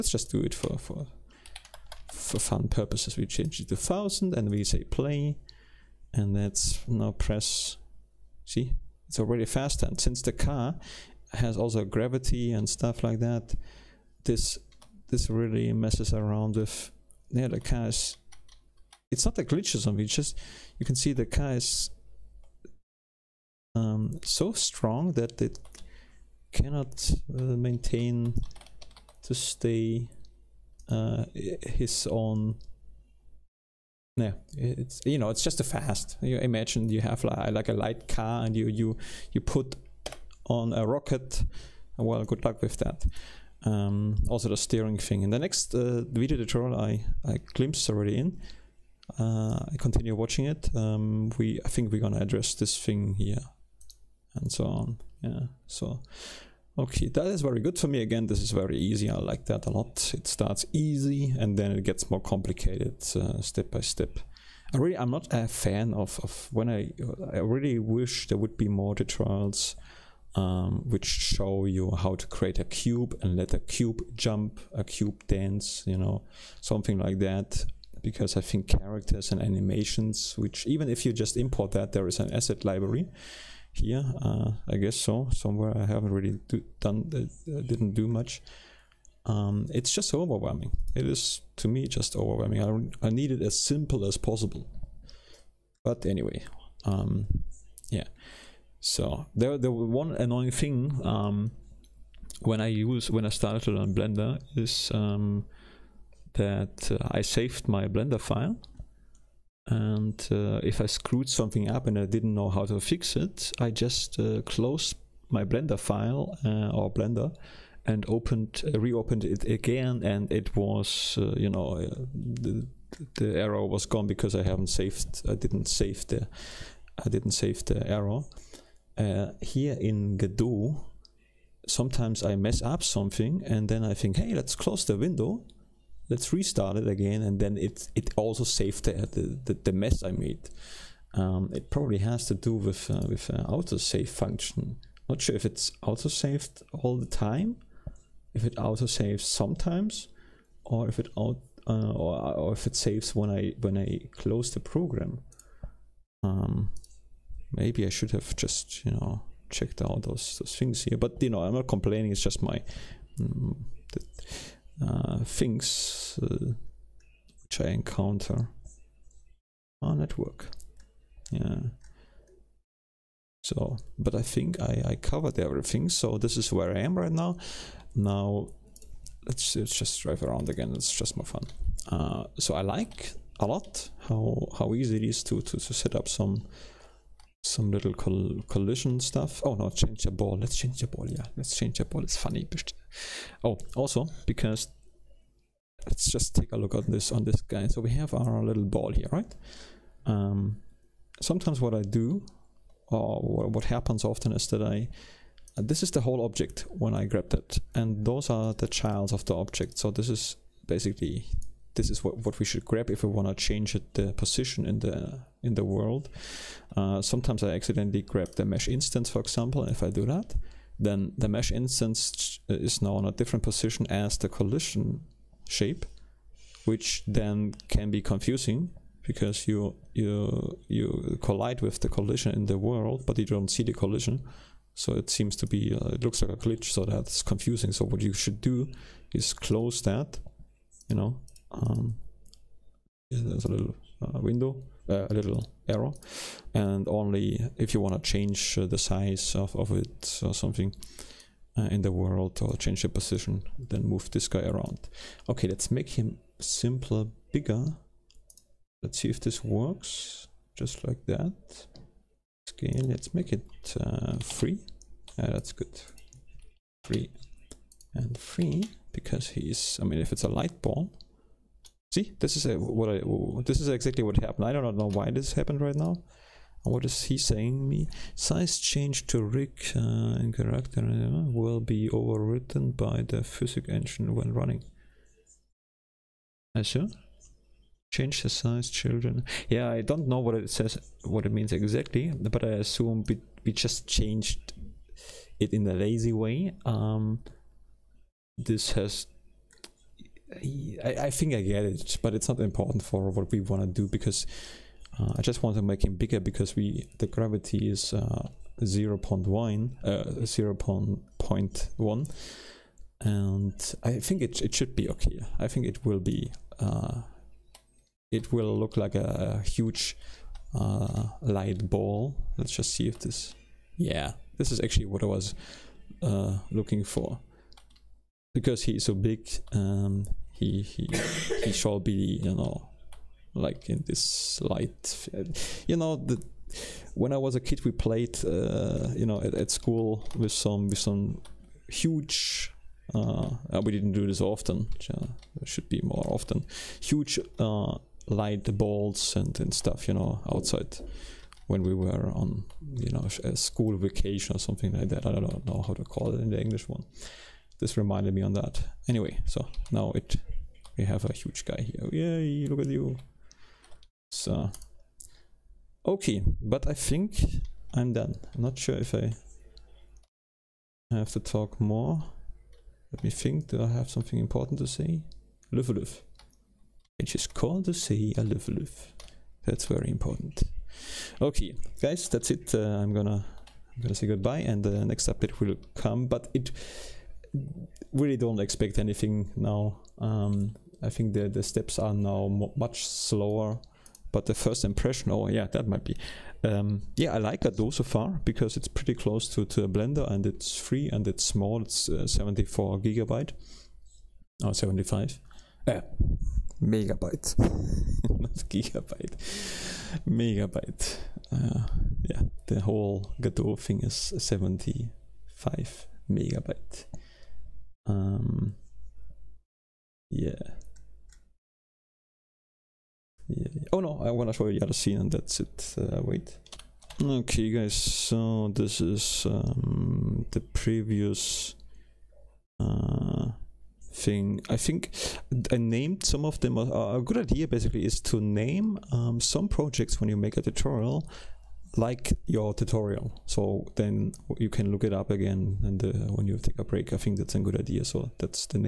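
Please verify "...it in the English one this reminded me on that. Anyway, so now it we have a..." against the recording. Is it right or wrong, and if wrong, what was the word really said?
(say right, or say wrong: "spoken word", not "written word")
right.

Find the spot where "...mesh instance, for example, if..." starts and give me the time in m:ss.
3:38.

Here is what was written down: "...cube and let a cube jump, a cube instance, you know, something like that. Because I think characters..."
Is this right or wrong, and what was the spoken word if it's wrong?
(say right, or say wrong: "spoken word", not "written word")
wrong: "dance", not "instance".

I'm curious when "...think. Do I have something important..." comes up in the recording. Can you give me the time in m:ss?
6:13.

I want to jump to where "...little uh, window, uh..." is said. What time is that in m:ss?
4:03.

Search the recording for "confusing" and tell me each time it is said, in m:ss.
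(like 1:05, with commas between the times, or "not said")
3:48, 3:57.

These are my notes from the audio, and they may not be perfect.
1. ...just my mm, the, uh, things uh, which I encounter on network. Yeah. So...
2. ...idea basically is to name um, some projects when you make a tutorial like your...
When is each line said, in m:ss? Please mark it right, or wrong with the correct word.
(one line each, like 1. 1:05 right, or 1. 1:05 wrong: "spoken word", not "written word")
1. 2:42 right
2. 7:17 right.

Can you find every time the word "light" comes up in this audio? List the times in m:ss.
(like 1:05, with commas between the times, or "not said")
0:37, 4:30, 5:21, 5:34, 5:48.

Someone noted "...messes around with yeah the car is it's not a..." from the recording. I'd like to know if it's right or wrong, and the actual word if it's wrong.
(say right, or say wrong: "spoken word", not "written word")
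right.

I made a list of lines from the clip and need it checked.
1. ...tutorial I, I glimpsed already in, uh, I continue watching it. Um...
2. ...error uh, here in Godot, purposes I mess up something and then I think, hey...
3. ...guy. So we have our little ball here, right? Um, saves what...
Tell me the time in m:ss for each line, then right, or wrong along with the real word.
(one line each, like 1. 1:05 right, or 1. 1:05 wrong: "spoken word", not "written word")
1. 0:46 right
2. 2:07 wrong: "sometimes", not "purposes"
3. 3:17 wrong: "sometimes", not "saves".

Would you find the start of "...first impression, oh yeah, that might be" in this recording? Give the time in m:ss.
6:34.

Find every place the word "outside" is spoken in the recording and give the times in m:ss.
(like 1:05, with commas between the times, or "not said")
5:50.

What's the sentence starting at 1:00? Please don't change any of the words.
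It starts easy and then it gets more complicated uh, step by step.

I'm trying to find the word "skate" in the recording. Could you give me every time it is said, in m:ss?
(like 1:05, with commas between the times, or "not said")
not said.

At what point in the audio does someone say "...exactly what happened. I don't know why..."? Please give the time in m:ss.
4:33.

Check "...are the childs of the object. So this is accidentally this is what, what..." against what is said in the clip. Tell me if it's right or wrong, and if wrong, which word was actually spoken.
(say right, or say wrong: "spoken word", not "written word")
wrong: "basically", not "accidentally".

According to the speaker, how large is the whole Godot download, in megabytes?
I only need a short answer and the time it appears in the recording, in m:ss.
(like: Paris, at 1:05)
75 megabytes, at 6:54.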